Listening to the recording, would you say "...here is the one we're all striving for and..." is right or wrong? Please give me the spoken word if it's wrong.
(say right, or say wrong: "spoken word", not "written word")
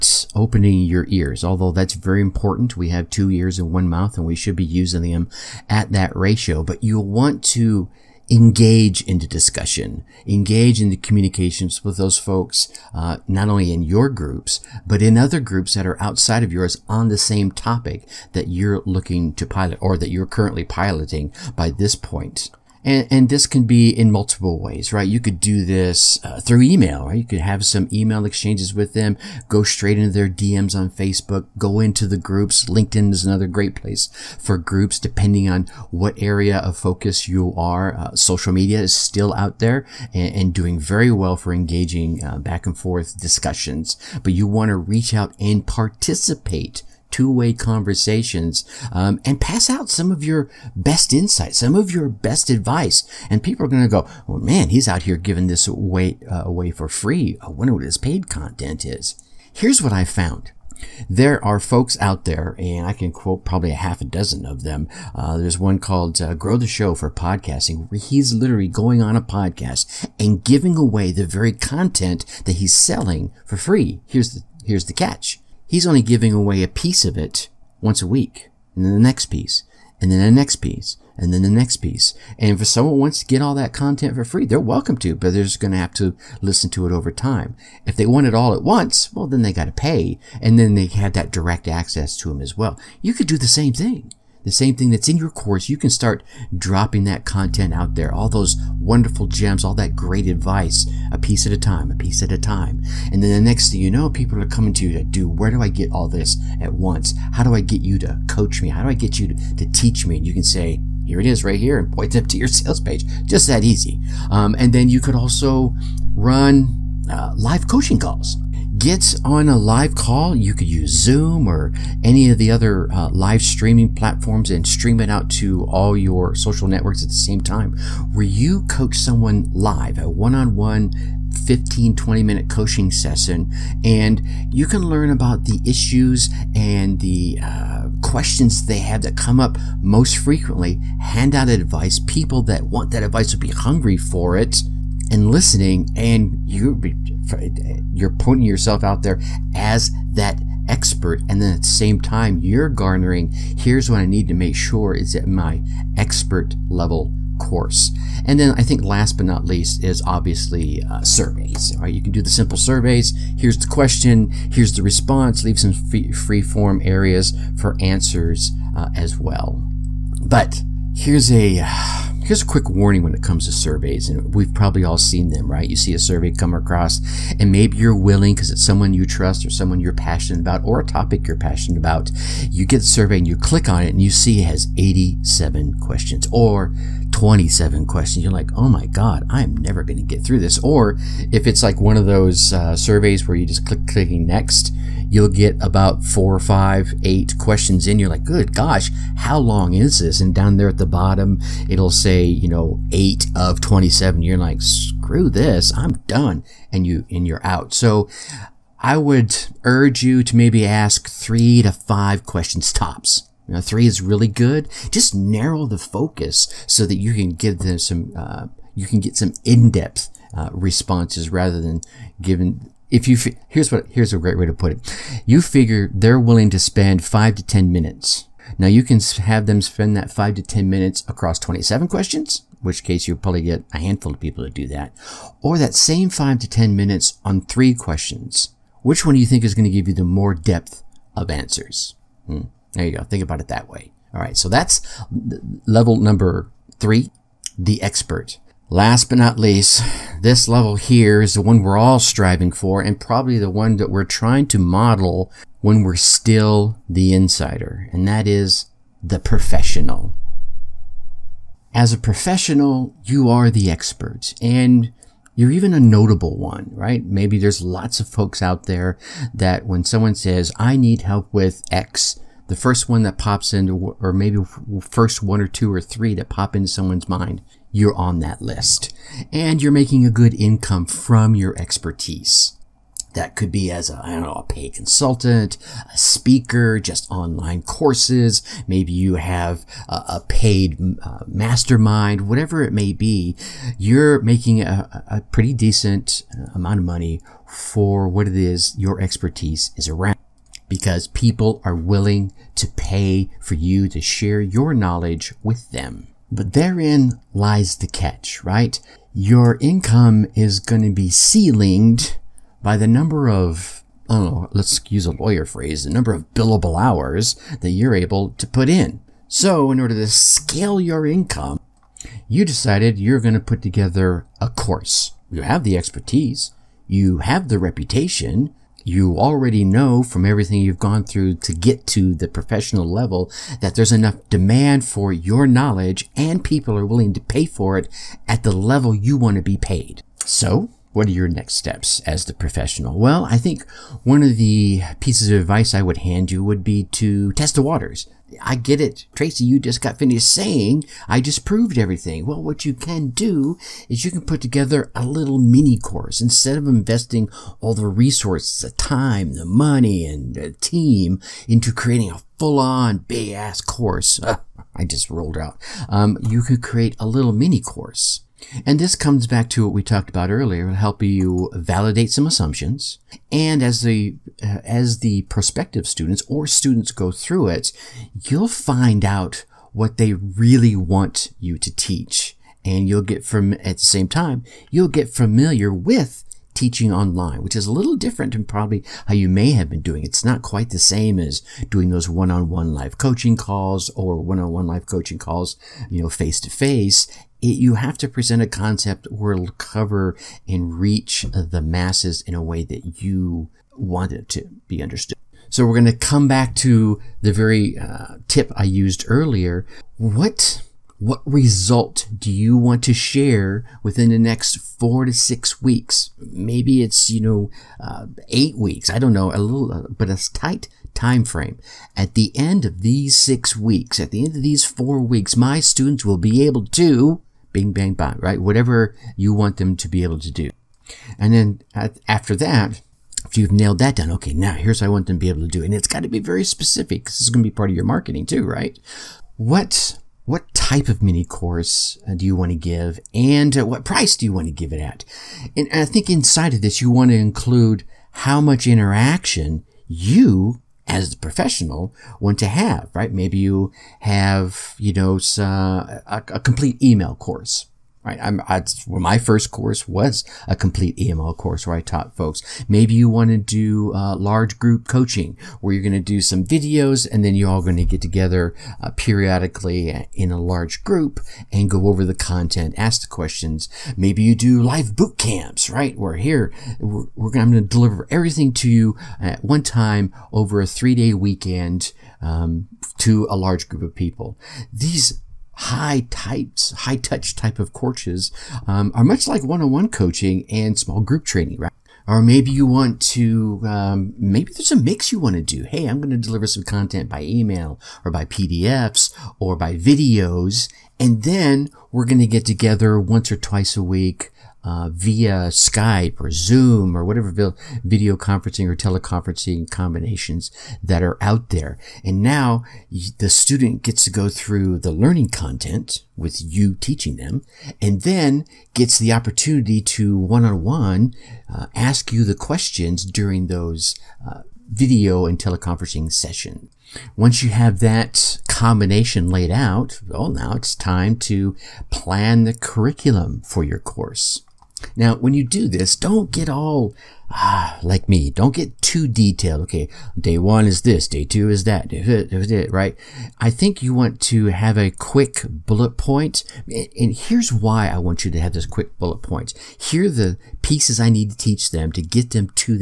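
right.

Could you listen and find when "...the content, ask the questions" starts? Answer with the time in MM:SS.
07:52.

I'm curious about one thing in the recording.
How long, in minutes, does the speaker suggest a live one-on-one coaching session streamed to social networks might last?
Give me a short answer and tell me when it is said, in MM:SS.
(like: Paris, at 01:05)
15-20 minutes, at 02:11.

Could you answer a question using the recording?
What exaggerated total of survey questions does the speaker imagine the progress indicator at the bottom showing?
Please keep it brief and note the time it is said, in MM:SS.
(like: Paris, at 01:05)
27, at 03:22.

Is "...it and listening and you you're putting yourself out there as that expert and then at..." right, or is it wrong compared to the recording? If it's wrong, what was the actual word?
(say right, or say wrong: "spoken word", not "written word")
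right.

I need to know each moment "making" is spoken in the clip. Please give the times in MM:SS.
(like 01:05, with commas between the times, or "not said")
04:39, 04:54.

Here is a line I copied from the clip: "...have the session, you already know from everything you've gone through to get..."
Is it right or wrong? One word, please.
wrong.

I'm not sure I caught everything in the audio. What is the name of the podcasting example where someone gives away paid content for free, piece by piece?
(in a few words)
Grow the Show.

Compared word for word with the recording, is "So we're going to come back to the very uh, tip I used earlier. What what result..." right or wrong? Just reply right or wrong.
right.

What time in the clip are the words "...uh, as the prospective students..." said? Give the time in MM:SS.
06:14.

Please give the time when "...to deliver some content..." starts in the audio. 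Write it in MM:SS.
08:16.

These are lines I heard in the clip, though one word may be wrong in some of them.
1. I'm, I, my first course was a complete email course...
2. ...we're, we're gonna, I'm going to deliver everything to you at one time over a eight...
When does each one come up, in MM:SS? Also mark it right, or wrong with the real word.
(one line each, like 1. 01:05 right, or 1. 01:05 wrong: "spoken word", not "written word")
1. 07:38 right
2. 07:56 wrong: "three", not "eight".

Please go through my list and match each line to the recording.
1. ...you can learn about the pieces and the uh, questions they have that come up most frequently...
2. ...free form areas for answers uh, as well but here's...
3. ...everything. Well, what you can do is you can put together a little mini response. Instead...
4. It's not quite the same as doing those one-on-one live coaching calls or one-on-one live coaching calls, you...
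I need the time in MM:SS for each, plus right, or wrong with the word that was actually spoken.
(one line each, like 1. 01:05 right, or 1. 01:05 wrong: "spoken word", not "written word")
1. 02:14 wrong: "issues", not "pieces"
2. 02:46 right
3. 05:51 wrong: "course", not "response"
4. 06:30 right.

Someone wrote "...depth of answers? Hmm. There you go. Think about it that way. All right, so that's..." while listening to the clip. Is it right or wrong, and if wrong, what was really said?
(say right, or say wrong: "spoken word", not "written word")
right.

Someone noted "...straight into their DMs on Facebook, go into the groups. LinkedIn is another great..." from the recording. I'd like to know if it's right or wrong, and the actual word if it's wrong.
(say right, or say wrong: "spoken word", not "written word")
right.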